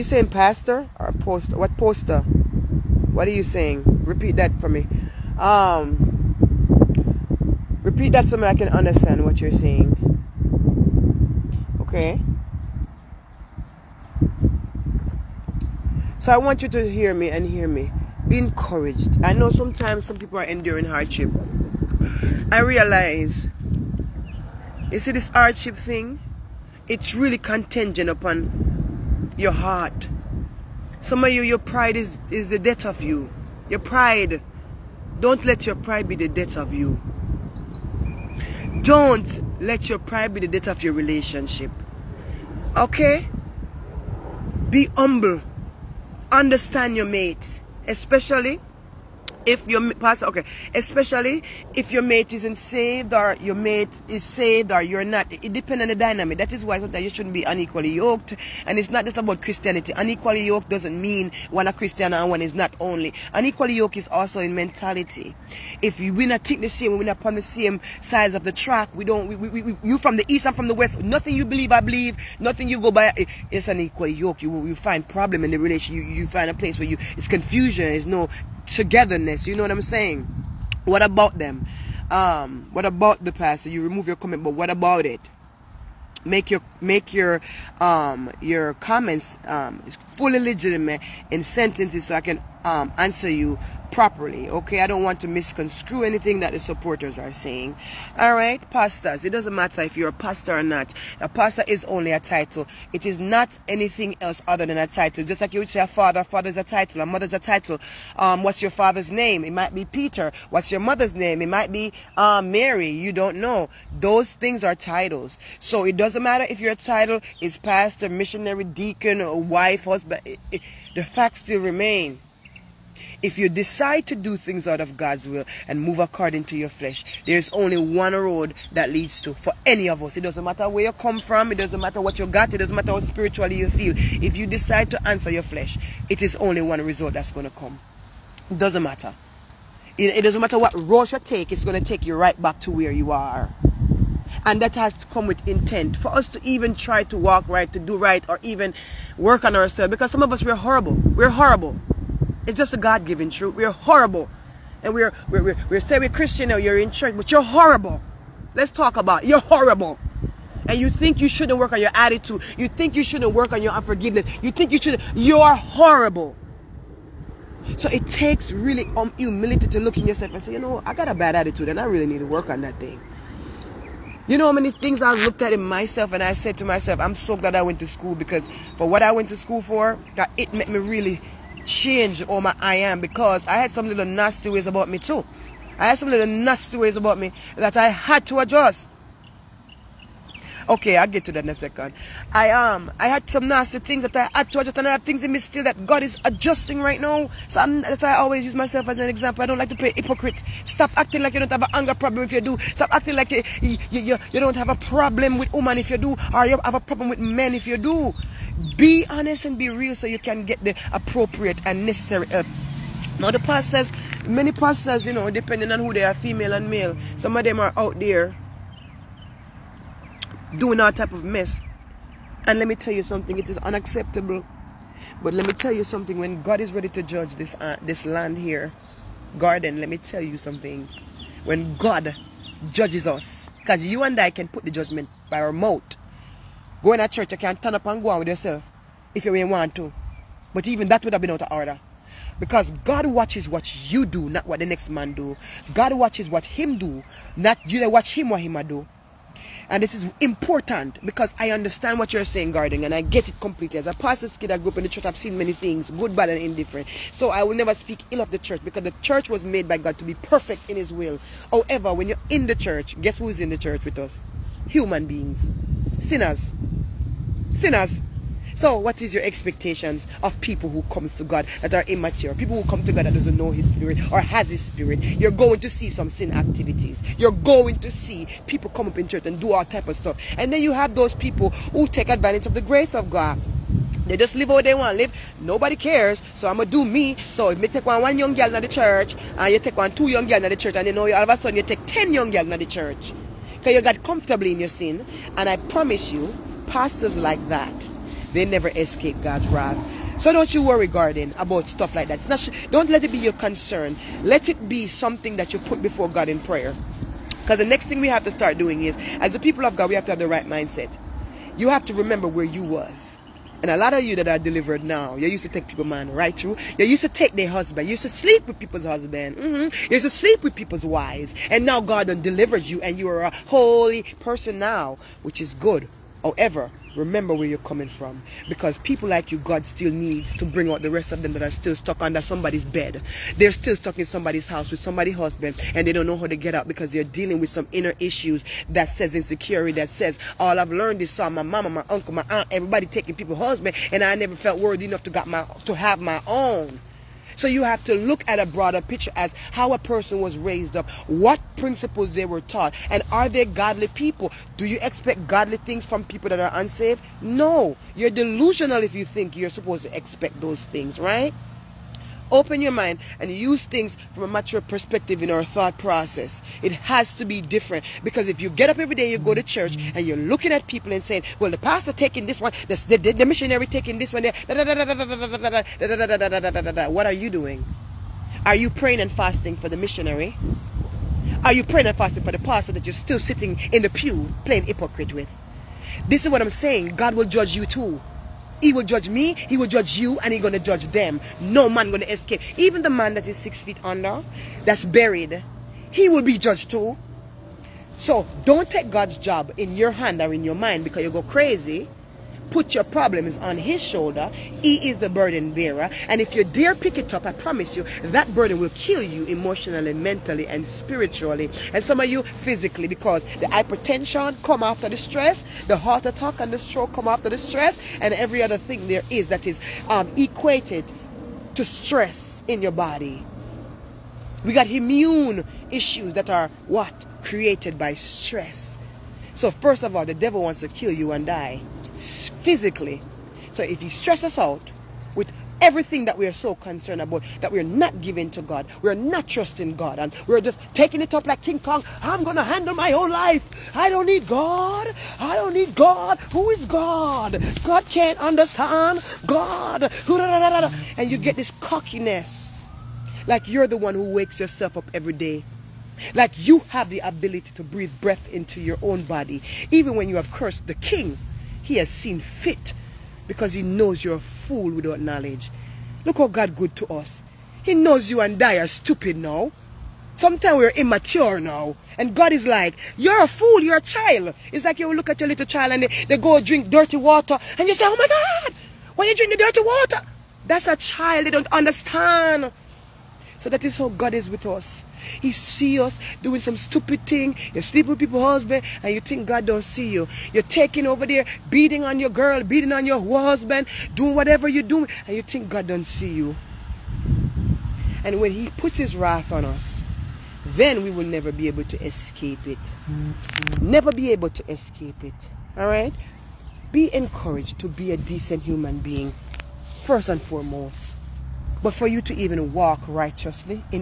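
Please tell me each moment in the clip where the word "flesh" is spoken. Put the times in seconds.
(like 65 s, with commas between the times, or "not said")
126 s, 135 s.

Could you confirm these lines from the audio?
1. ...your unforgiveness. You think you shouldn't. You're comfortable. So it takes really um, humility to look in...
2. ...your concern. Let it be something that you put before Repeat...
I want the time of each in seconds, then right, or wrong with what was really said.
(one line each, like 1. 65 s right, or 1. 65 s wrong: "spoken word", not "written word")
1. 163 s wrong: "horrible", not "comfortable"
2. 303 s wrong: "God", not "Repeat".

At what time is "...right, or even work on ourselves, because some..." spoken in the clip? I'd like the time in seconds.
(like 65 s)
147 s.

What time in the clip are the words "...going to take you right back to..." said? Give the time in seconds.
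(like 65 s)
141 s.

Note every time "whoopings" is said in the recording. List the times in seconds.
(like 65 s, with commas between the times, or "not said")
not said.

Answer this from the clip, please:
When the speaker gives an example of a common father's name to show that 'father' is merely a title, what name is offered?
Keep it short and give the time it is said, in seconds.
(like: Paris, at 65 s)
Peter, at 109 s.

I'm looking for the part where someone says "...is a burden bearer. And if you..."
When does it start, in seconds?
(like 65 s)
404 s.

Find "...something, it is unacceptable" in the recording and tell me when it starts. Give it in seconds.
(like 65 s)
223 s.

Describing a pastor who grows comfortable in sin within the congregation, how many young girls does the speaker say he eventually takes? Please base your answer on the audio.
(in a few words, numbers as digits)
10.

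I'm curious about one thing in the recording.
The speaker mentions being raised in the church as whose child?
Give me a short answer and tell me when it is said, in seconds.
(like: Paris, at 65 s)
A pastor's kid, at 253 s.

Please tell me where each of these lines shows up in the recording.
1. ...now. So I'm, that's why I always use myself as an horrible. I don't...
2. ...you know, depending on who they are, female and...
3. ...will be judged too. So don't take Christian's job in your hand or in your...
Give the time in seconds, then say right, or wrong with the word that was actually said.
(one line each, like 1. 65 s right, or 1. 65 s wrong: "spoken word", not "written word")
1. 197 s wrong: "example", not "horrible"
2. 215 s right
3. 396 s wrong: "God", not "Christian".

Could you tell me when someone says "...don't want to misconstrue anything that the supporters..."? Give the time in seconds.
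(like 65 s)
94 s.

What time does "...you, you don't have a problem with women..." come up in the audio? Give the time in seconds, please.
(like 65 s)
203 s.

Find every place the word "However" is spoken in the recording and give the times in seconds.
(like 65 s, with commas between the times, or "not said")
261 s, 326 s.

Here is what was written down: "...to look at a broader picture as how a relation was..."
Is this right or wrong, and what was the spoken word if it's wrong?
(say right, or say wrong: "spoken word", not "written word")
wrong: "person", not "relation".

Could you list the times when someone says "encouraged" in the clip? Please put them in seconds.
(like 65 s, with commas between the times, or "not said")
18 s, 506 s.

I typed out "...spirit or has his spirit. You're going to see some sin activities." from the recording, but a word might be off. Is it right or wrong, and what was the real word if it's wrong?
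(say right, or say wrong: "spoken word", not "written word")
right.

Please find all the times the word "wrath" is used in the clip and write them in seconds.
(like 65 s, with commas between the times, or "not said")
299 s, 498 s.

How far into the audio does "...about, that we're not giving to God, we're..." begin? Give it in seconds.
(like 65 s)
437 s.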